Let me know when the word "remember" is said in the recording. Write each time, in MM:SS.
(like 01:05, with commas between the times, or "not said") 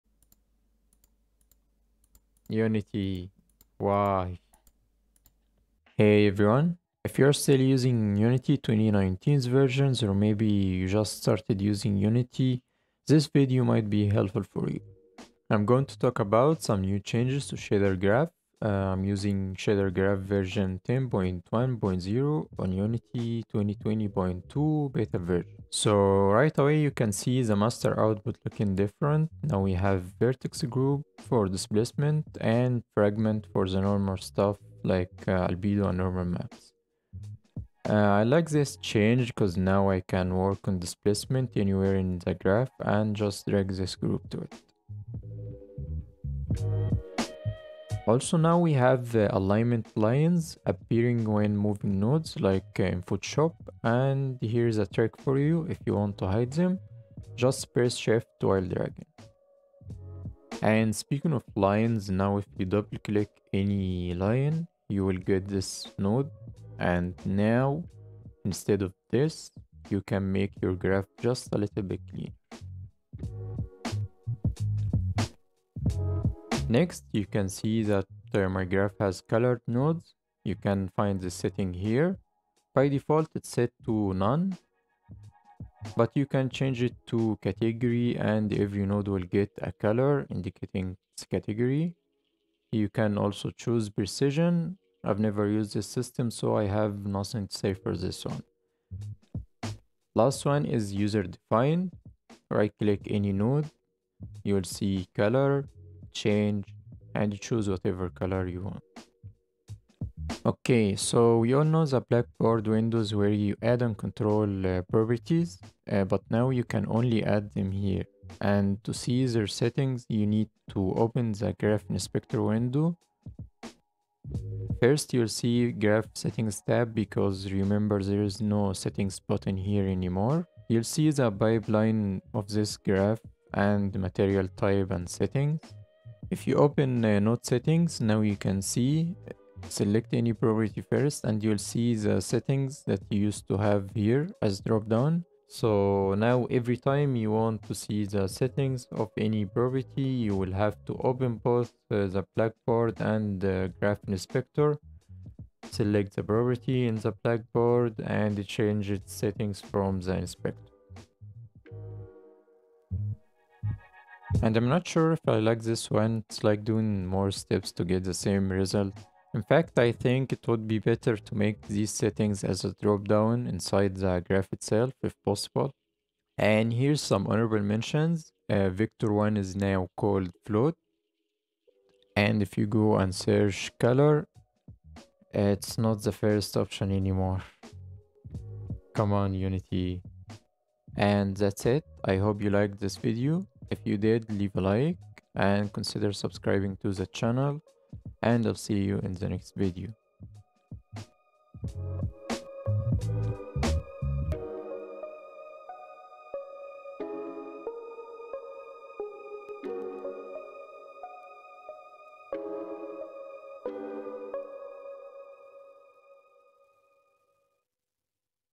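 02:07.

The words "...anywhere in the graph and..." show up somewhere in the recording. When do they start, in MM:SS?
00:41.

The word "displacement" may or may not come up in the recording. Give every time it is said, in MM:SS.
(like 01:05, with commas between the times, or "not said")
00:31, 00:40.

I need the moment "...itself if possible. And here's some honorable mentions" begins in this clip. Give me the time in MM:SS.
02:54.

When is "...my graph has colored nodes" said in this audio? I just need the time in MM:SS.
01:18.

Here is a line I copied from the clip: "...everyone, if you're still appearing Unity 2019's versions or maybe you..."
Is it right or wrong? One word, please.
wrong.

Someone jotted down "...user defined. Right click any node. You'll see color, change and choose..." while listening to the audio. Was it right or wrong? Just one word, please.
right.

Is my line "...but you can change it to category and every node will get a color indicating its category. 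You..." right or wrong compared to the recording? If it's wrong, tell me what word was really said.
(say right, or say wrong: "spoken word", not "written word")
right.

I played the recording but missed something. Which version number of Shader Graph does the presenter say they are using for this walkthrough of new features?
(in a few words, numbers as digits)
10.1.0.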